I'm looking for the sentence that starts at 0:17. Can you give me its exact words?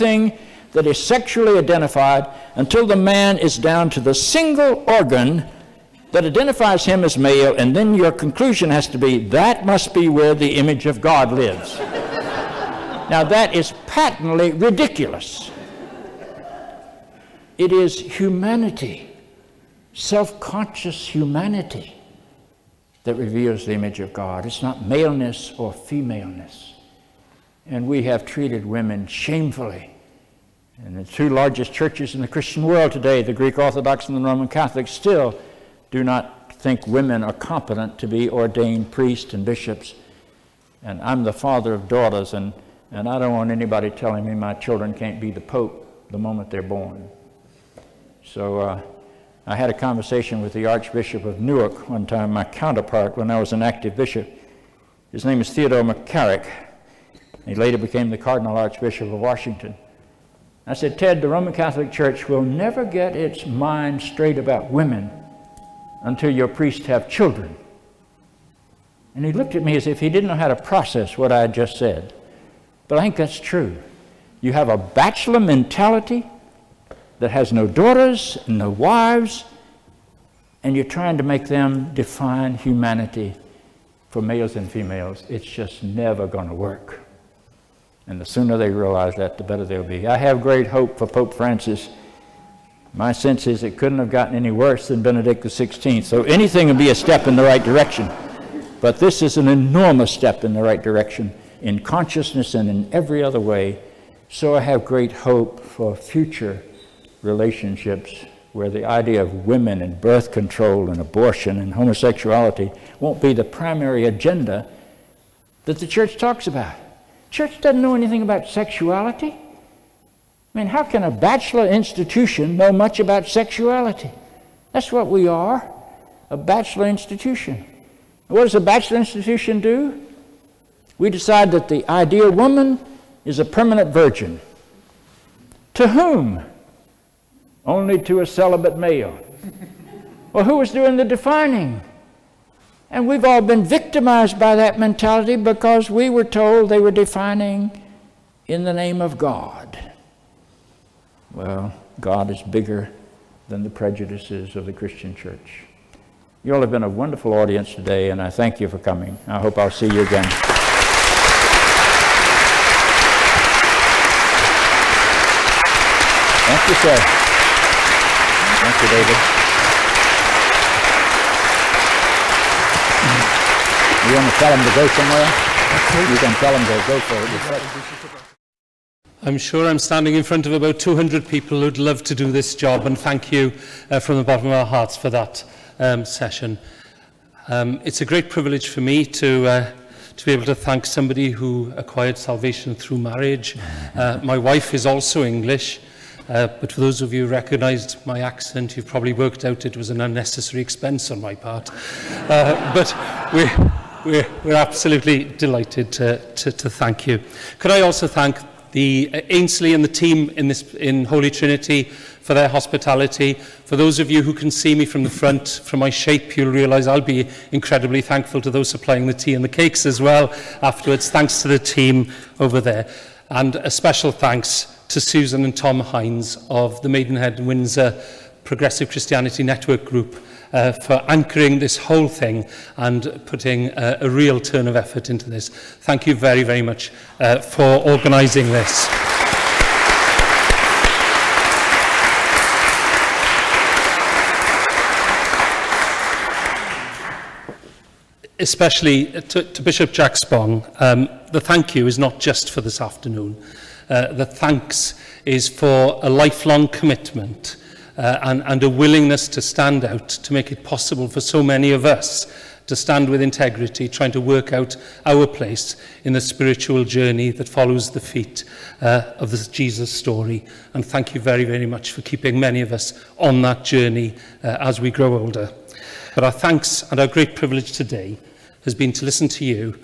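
It is humanity, self conscious humanity, that reveals the image of God.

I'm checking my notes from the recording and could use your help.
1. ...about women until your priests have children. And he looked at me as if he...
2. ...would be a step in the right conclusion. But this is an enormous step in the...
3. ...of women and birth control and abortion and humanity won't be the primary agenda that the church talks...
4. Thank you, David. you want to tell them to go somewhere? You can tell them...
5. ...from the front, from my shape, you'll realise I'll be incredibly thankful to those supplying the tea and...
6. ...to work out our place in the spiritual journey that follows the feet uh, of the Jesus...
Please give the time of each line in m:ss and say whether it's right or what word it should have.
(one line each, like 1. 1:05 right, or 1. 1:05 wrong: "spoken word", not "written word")
1. 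1:04 right
2. 1:36 wrong: "direction", not "conclusion"
3. 1:49 wrong: "homosexuality", not "humanity"
4. 2:48 right
5. 3:34 right
6. 4:24 right.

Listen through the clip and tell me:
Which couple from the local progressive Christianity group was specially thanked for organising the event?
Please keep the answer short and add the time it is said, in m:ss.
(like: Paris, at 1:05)
Susan and Tom Hines, at 3:45.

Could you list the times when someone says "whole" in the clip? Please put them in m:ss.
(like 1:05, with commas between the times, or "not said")
3:51.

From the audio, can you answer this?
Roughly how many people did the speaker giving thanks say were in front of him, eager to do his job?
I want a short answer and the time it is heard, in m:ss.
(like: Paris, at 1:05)
200, at 3:00.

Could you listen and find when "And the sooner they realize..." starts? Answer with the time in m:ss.
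1:28.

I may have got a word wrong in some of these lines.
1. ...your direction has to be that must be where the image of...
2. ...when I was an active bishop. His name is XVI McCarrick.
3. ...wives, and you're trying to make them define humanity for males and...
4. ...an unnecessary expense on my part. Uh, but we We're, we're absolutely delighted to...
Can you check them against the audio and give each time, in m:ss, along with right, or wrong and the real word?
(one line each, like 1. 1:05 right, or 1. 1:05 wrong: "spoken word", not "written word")
1. 0:07 wrong: "conclusion", not "direction"
2. 0:53 wrong: "Theodore", not "XVI"
3. 1:18 right
4. 3:19 right.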